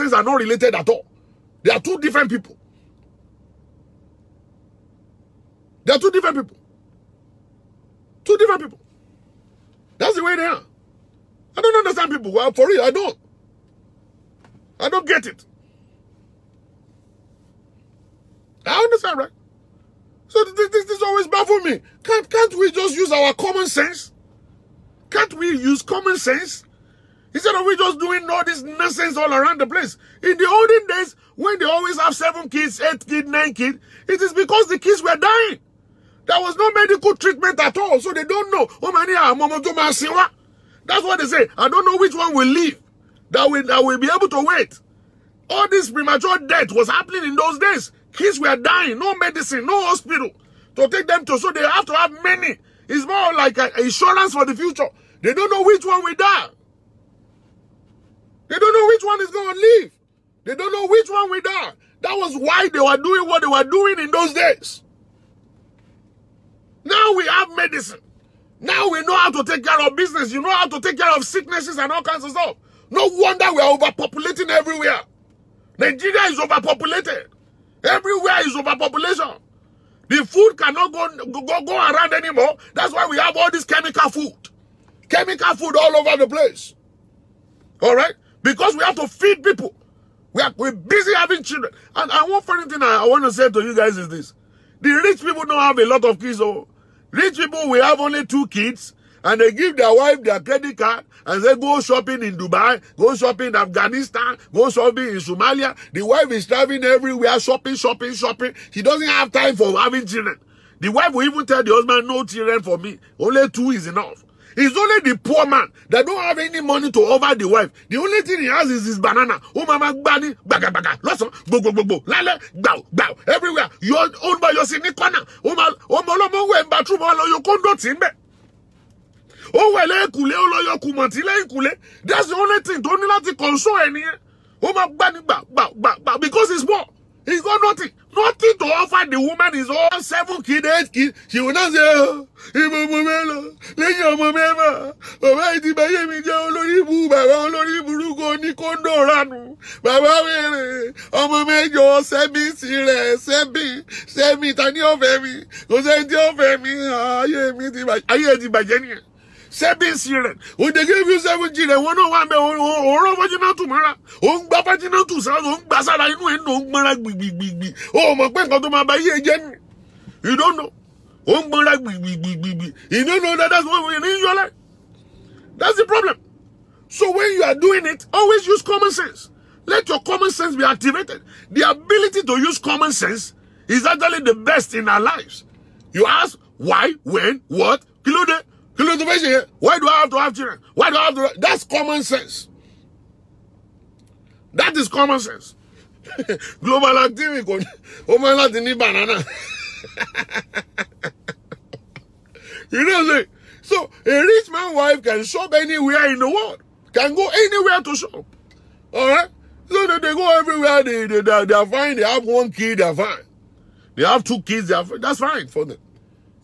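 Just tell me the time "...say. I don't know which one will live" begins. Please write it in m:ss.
0:41.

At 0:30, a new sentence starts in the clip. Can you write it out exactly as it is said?
In the olden days, when they always have seven kids, eight kids, nine kids, it is because the kids were dying.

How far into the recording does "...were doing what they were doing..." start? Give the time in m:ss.
1:02.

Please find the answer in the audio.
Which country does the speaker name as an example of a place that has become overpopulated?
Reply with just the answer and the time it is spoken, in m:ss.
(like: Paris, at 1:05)
Nigeria, at 1:15.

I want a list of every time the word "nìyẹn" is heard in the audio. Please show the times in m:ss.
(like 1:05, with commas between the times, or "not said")
2:13, 2:38.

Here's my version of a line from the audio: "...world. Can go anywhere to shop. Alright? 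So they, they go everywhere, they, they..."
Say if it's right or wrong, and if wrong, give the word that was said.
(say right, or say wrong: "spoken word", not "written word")
right.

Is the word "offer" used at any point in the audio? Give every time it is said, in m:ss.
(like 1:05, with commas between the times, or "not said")
1:57, 2:18.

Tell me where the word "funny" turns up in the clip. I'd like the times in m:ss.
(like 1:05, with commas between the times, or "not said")
1:32.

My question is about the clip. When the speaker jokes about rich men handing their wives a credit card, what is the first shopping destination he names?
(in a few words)
Dubai.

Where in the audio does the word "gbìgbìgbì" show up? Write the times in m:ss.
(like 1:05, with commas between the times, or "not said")
2:47, 2:51.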